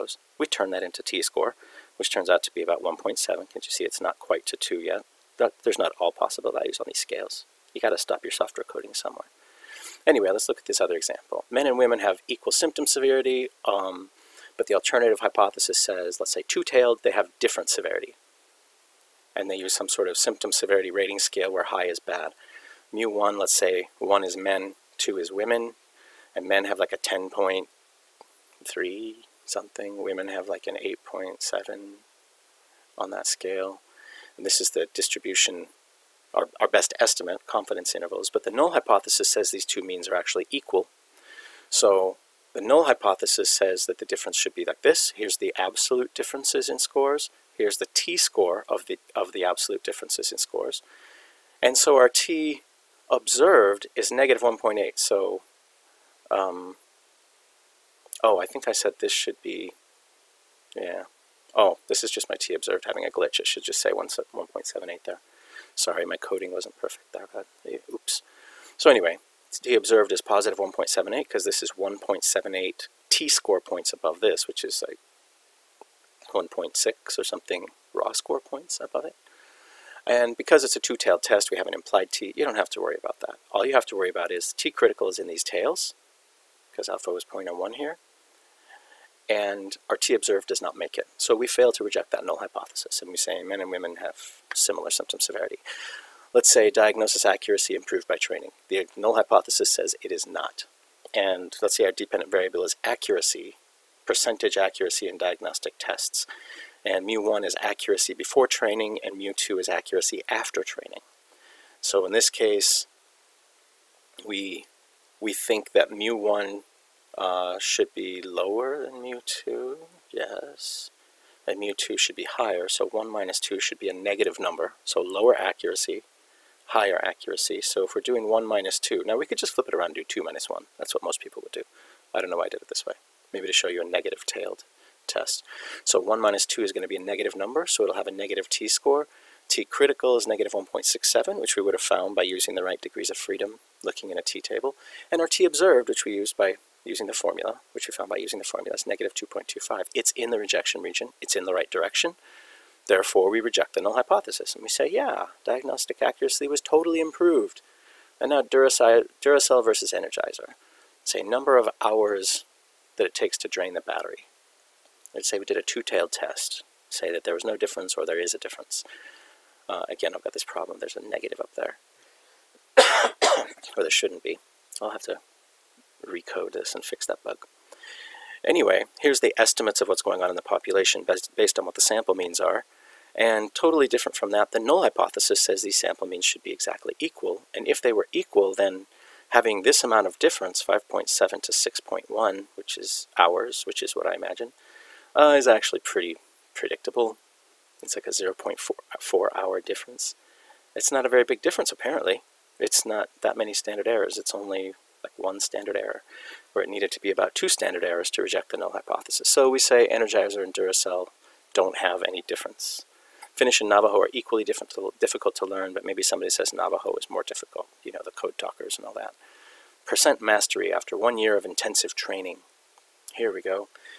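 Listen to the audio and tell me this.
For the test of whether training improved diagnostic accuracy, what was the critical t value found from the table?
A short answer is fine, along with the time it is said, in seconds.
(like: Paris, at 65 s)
-1.67, at 140 s.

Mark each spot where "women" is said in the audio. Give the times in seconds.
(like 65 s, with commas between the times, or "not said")
11 s, 25 s, 30 s, 93 s.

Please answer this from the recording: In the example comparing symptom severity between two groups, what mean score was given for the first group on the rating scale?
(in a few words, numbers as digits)
10.3.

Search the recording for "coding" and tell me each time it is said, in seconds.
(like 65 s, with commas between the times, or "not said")
8 s, 66 s.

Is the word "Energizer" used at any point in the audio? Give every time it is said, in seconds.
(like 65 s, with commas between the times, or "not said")
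159 s, 209 s.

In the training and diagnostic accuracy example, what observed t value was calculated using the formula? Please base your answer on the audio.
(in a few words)
-2.25.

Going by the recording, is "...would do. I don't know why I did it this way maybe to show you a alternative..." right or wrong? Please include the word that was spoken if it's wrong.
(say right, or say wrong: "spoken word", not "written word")
wrong: "negative", not "alternative".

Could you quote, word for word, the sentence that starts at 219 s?
Percent mastery after one year of intensive training.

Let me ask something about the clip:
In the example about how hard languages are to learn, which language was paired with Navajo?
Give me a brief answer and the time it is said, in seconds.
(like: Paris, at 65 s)
Finnish, at 213 s.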